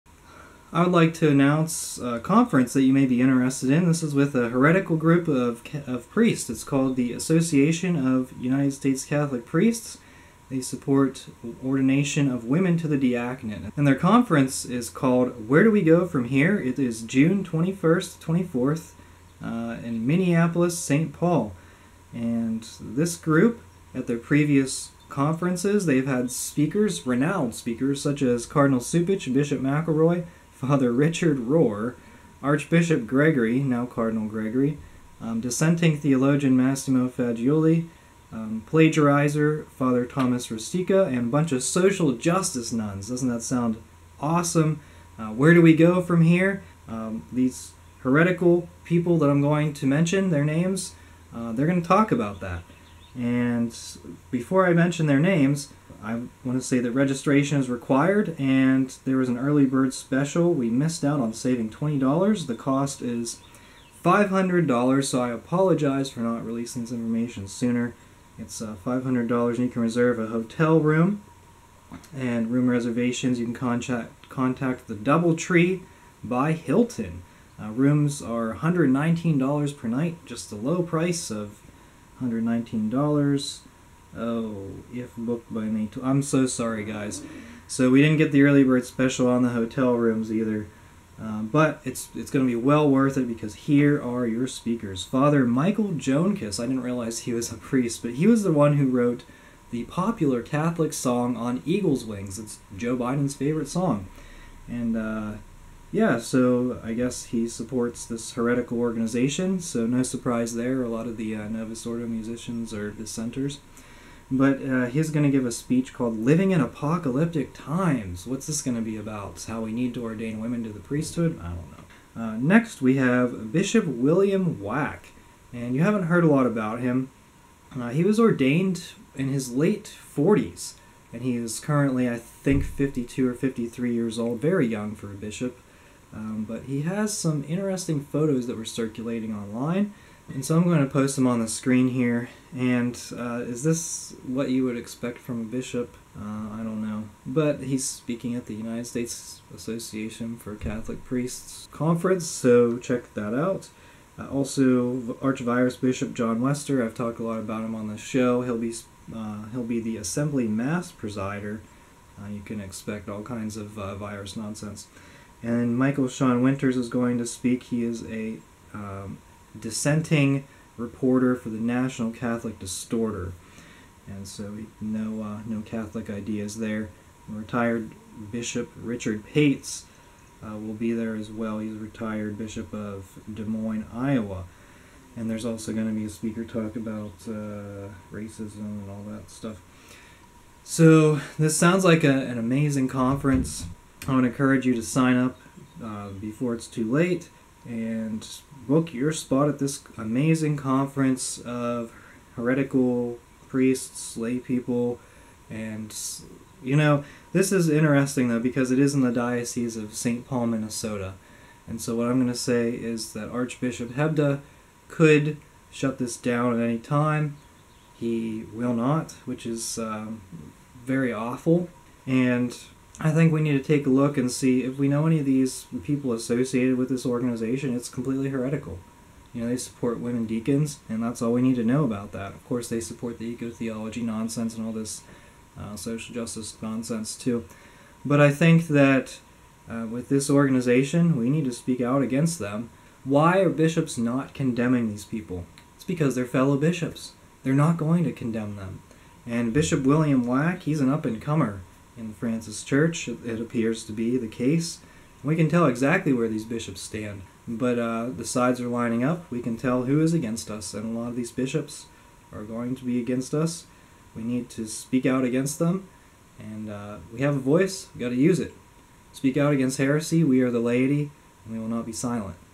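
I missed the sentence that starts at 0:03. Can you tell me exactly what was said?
This is with a heretical group of, of priests.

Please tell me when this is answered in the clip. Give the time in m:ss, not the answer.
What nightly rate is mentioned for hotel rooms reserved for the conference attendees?
1:18.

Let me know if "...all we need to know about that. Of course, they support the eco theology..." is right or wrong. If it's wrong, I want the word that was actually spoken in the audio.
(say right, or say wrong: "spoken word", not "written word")
right.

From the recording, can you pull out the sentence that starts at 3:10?
So this sounds like a, an amazing conference.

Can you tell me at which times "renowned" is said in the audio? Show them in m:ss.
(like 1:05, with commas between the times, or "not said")
0:27.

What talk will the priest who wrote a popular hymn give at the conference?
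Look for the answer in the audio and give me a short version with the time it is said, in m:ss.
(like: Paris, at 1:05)
Living in Apocalyptic Times, at 1:56.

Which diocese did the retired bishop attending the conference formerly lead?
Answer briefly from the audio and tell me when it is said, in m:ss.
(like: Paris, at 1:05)
Des Moines, Iowa, at 3:03.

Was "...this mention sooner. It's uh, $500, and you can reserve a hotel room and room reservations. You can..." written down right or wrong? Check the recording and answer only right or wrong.
wrong.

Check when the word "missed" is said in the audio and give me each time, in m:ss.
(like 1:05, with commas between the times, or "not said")
1:00.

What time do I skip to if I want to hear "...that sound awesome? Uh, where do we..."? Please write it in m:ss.
0:43.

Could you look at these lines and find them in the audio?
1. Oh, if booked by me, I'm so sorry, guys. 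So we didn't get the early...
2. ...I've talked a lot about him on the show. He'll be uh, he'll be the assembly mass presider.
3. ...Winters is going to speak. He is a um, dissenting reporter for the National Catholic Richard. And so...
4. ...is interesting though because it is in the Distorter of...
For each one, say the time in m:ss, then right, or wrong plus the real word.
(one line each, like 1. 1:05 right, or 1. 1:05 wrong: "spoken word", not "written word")
1. 1:24 right
2. 2:36 right
3. 2:46 wrong: "Distorter", not "Richard"
4. 3:27 wrong: "Diocese", not "Distorter".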